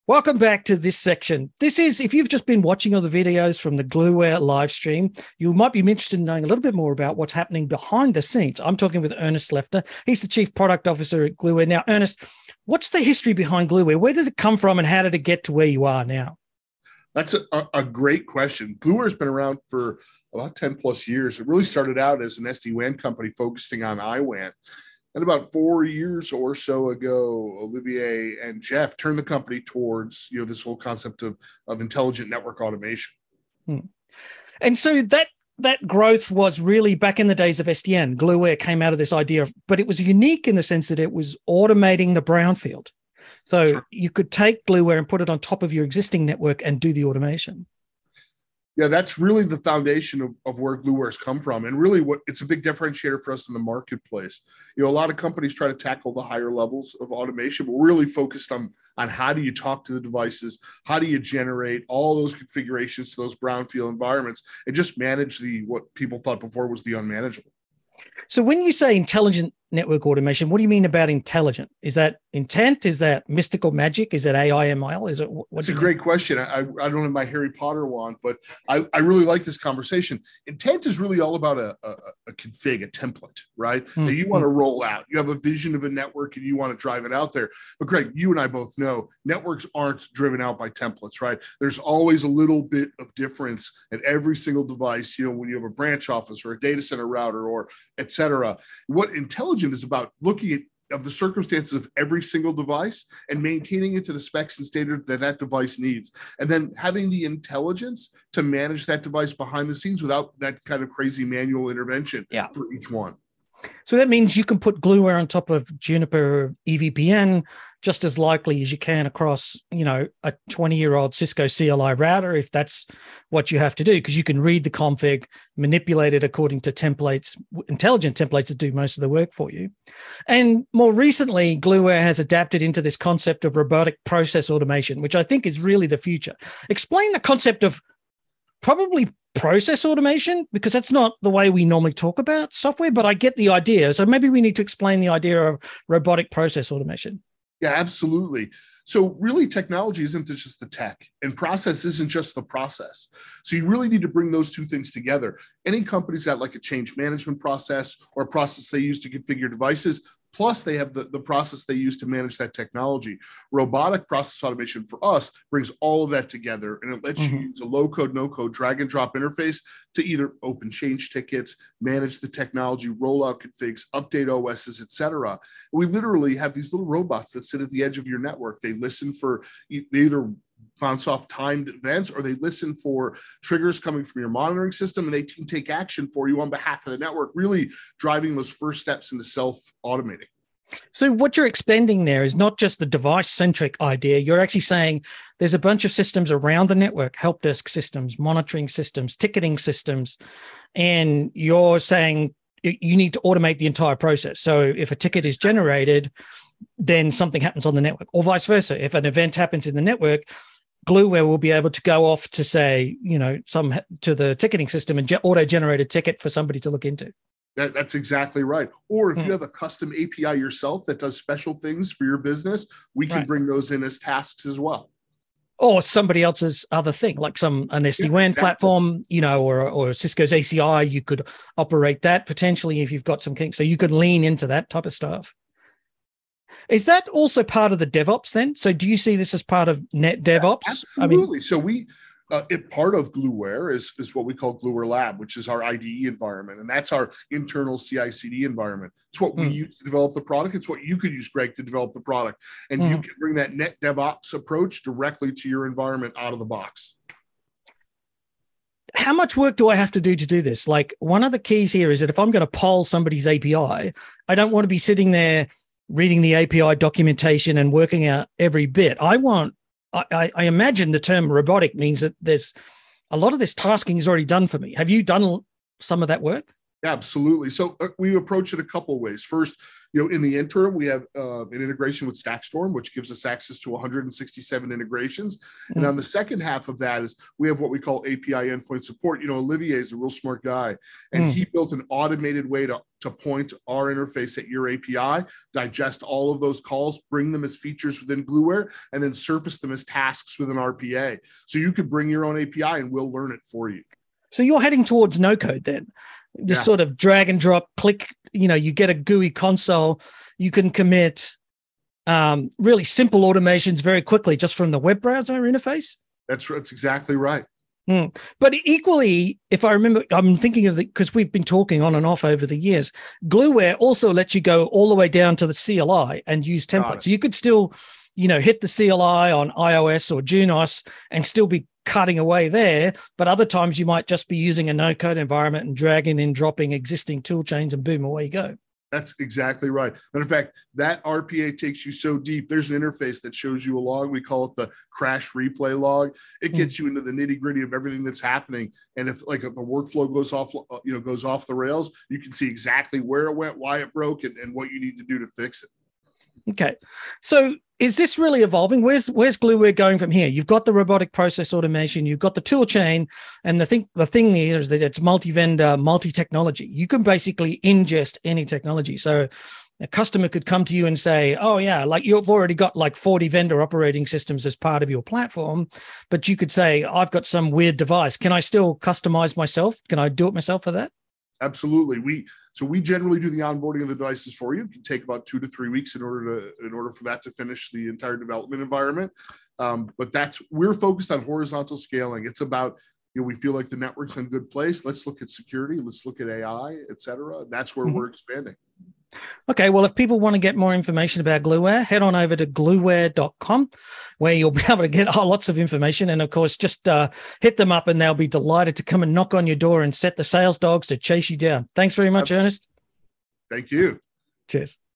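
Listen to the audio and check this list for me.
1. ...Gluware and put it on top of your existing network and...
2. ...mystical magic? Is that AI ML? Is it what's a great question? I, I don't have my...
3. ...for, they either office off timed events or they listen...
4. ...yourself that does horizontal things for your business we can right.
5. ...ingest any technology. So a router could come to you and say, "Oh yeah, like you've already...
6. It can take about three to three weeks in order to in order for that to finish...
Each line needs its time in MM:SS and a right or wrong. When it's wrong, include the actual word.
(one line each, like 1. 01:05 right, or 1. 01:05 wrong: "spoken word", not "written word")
1. 00:44 right
2. 01:13 right
3. 02:59 wrong: "bounce", not "office"
4. 03:40 wrong: "special", not "horizontal"
5. 06:07 wrong: "customer", not "router"
6. 06:24 wrong: "two", not "three".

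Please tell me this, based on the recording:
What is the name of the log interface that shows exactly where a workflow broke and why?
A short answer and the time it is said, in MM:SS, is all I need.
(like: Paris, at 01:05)
crash replay log, at 05:44.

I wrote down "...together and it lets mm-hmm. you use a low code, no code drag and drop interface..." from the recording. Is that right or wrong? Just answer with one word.
right.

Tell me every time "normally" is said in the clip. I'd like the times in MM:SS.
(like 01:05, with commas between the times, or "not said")
02:21.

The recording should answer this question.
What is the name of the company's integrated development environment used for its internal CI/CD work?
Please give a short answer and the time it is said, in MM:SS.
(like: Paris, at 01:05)
Gluware Lab, at 04:04.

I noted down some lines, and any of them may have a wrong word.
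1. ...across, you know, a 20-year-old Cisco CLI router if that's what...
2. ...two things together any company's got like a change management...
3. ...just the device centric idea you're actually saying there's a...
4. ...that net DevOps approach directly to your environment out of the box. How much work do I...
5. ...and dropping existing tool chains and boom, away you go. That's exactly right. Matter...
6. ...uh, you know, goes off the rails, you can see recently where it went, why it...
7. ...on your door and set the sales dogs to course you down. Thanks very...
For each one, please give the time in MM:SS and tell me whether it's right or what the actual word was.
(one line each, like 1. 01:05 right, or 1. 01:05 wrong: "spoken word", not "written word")
1. 01:59 right
2. 02:34 right
3. 03:12 right
4. 04:13 right
5. 05:36 right
6. 05:50 wrong: "exactly", not "recently"
7. 06:49 wrong: "chase", not "course".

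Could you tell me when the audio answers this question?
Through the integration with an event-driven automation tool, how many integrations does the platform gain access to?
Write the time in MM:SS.
04:43.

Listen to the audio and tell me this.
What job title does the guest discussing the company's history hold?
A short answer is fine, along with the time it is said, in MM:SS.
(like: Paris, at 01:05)
Chief Product Officer, at 00:10.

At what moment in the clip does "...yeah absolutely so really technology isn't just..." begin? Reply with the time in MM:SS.
02:27.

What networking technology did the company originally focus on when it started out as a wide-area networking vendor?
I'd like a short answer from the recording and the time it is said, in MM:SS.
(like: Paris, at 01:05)
IWAN, at 00:24.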